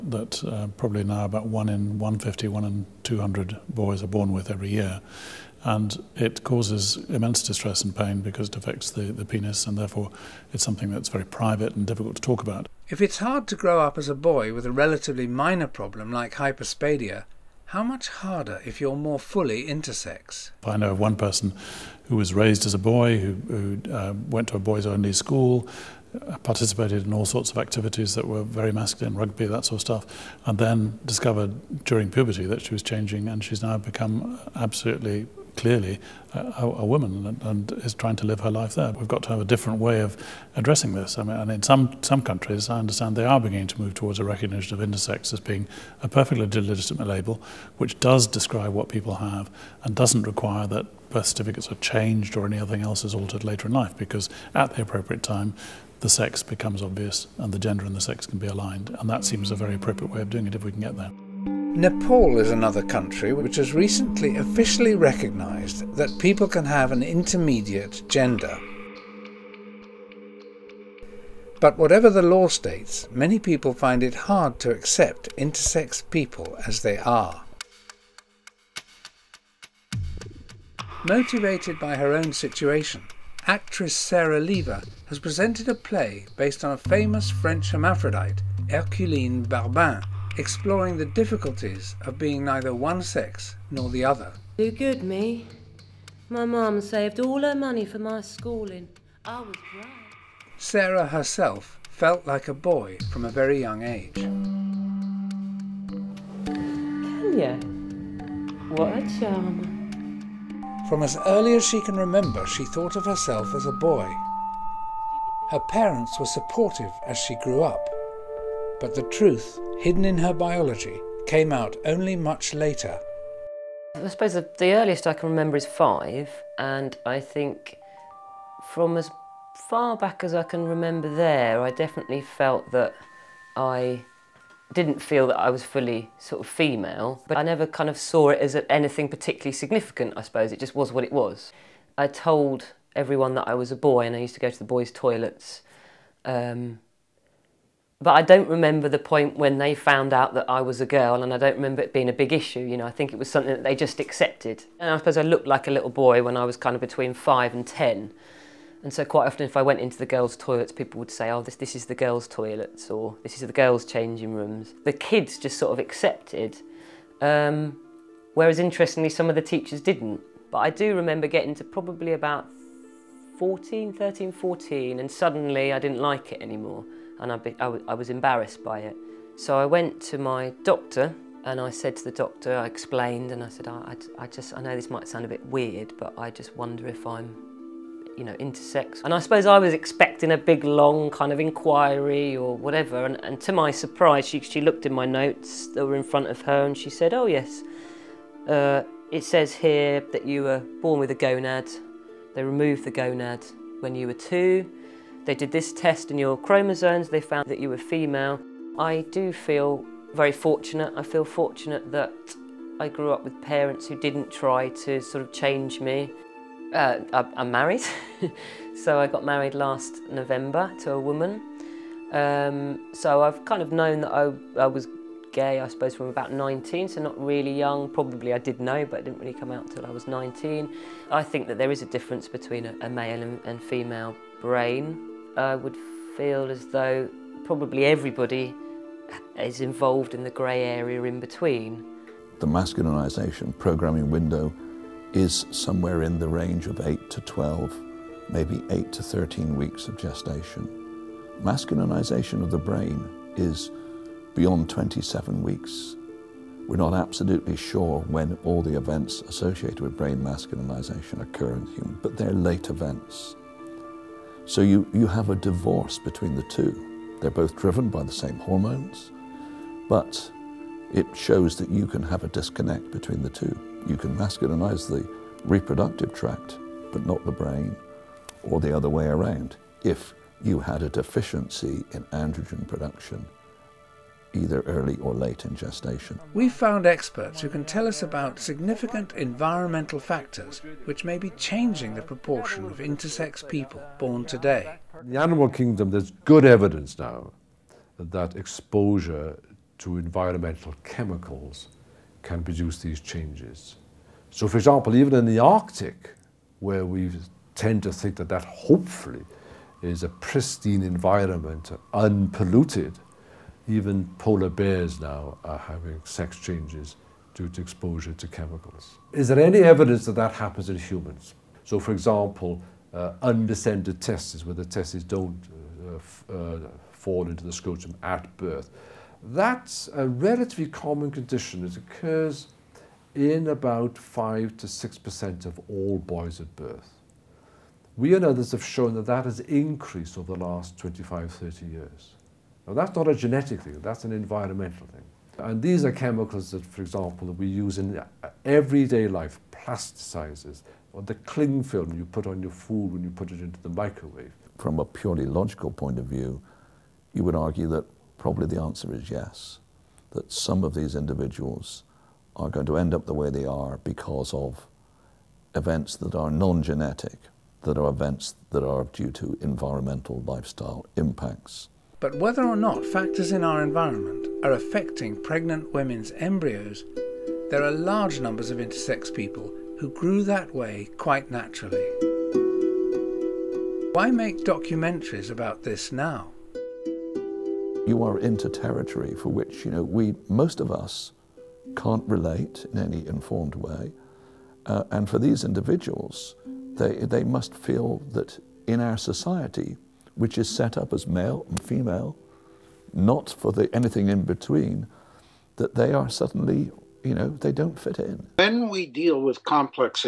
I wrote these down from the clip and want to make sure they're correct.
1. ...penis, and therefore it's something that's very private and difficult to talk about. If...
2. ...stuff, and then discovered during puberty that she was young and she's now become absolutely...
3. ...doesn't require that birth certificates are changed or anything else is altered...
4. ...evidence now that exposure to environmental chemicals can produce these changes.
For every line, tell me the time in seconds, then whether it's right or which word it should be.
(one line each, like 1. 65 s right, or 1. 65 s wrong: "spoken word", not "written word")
1. 9 s right
2. 29 s wrong: "changing", not "young"
3. 49 s right
4. 296 s right.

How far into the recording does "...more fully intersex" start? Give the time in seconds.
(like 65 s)
18 s.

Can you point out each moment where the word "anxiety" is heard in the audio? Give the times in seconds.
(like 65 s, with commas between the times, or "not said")
not said.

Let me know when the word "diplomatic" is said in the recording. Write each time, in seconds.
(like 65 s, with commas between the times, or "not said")
not said.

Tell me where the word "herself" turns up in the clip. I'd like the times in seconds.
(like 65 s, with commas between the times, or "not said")
101 s, 113 s.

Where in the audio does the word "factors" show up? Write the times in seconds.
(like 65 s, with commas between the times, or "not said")
289 s, 372 s.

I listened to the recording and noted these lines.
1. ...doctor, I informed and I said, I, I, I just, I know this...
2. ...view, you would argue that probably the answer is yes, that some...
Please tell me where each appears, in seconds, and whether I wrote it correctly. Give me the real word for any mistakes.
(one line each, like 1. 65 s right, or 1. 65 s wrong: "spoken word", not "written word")
1. 182 s wrong: "explained", not "informed"
2. 356 s right.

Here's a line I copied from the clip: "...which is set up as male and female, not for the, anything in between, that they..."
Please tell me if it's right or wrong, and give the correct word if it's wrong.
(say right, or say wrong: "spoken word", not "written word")
right.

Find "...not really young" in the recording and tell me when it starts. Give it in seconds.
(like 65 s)
227 s.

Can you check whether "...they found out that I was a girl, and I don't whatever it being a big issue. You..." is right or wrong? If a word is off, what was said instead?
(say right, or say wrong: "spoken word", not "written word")
wrong: "remember", not "whatever".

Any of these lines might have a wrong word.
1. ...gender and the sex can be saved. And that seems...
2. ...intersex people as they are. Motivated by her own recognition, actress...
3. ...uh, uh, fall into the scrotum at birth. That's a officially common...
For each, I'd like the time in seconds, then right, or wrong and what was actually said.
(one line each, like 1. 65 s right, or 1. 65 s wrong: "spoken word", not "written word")
1. 57 s wrong: "aligned", not "saved"
2. 75 s wrong: "situation", not "recognition"
3. 325 s wrong: "relatively", not "officially".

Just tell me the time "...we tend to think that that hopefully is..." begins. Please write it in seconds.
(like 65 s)
306 s.